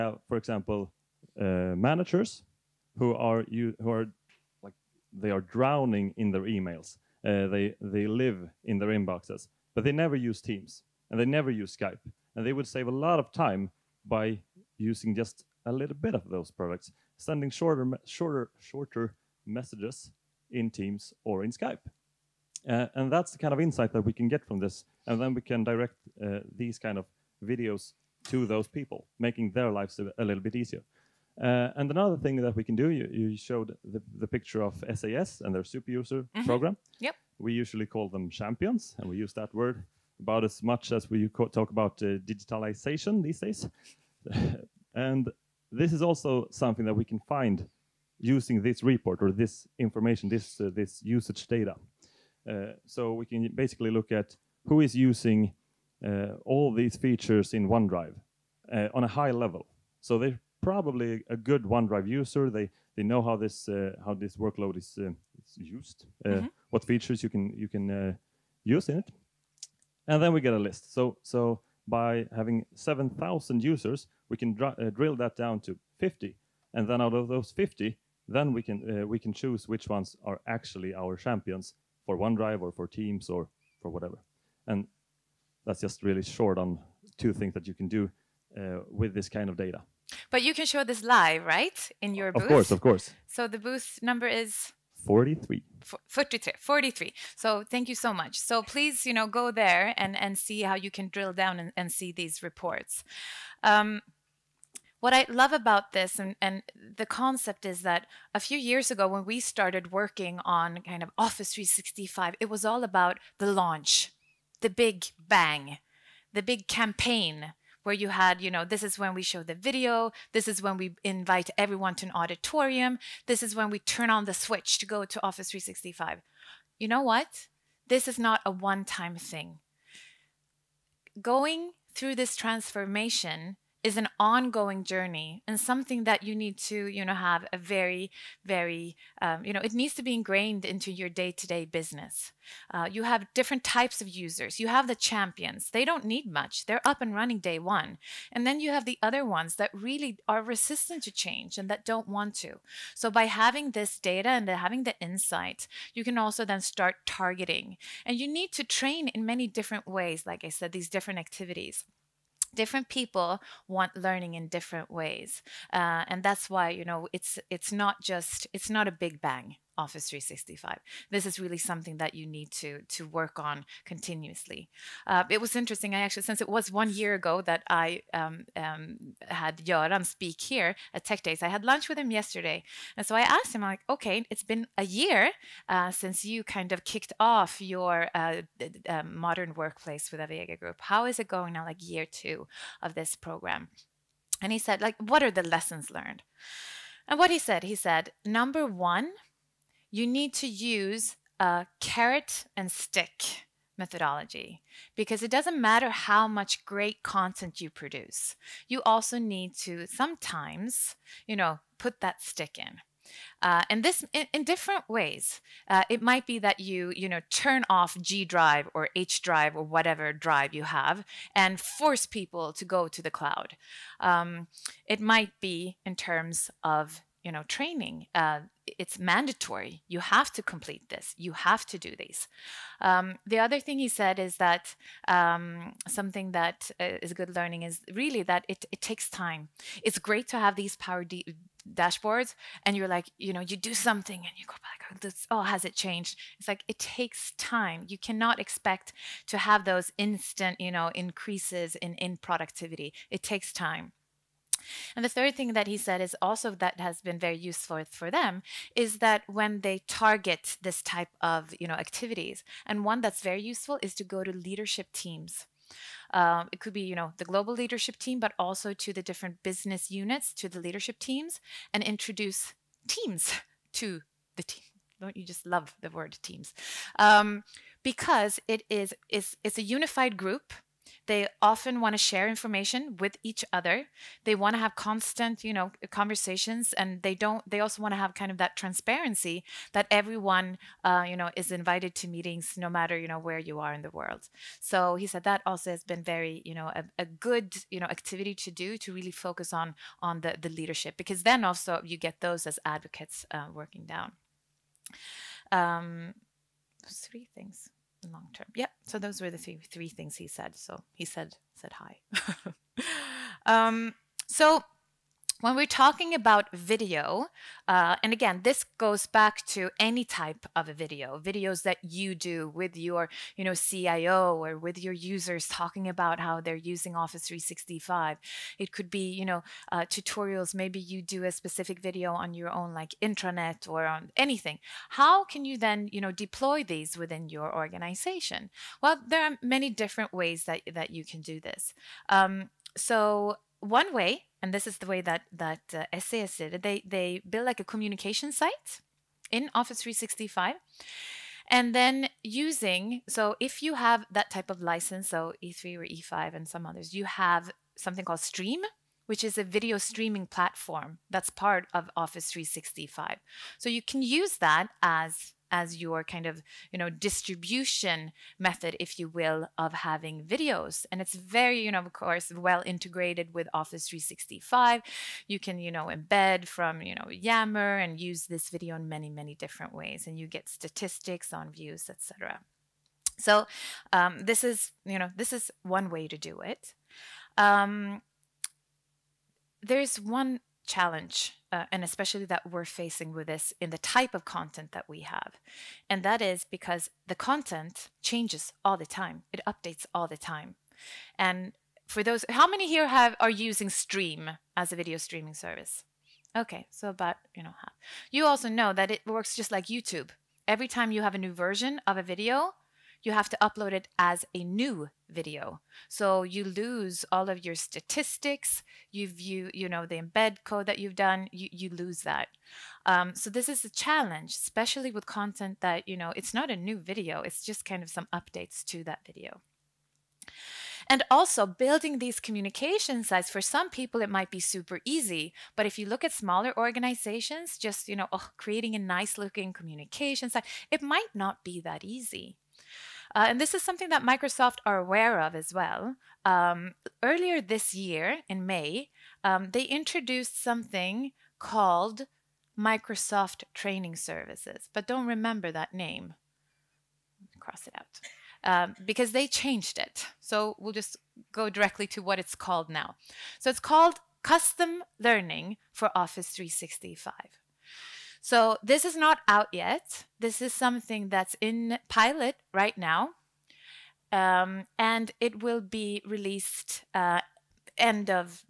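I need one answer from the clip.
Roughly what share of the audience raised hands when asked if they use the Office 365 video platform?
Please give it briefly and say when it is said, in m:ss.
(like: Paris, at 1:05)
Half, at 6:46.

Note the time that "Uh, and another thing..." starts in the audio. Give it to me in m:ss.
0:31.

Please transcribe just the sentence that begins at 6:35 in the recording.
And that is because the content changes all the time, it updates all the time.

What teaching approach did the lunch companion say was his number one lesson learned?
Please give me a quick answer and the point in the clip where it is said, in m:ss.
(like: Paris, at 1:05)
Carrot and stick, at 3:21.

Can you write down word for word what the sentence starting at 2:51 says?
This is really something that you need to to work on continuously.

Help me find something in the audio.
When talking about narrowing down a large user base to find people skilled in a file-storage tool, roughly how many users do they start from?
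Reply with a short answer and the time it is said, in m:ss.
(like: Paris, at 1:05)
7,000, at 1:12.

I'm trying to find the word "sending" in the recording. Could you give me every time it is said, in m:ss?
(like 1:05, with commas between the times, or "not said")
0:17.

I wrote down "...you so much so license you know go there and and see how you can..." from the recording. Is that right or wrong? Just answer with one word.
wrong.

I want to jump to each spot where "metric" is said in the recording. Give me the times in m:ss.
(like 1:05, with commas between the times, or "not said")
not said.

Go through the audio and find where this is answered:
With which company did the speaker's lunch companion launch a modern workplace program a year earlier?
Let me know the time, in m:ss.
3:10.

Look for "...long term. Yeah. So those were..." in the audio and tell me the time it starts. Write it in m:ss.
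5:08.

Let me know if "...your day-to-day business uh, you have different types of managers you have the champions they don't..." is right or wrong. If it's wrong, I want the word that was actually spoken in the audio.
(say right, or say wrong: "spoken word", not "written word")
wrong: "users", not "managers".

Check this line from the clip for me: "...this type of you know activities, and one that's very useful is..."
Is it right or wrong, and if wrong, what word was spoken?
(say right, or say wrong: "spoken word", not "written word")
right.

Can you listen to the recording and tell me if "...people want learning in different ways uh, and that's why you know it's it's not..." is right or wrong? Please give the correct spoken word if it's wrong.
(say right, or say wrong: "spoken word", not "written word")
right.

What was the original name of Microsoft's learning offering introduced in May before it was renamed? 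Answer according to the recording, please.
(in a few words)
Microsoft Training Services.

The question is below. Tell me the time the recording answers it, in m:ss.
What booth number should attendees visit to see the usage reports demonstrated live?
1:33.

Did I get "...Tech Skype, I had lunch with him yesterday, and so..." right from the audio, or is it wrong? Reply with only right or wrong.
wrong.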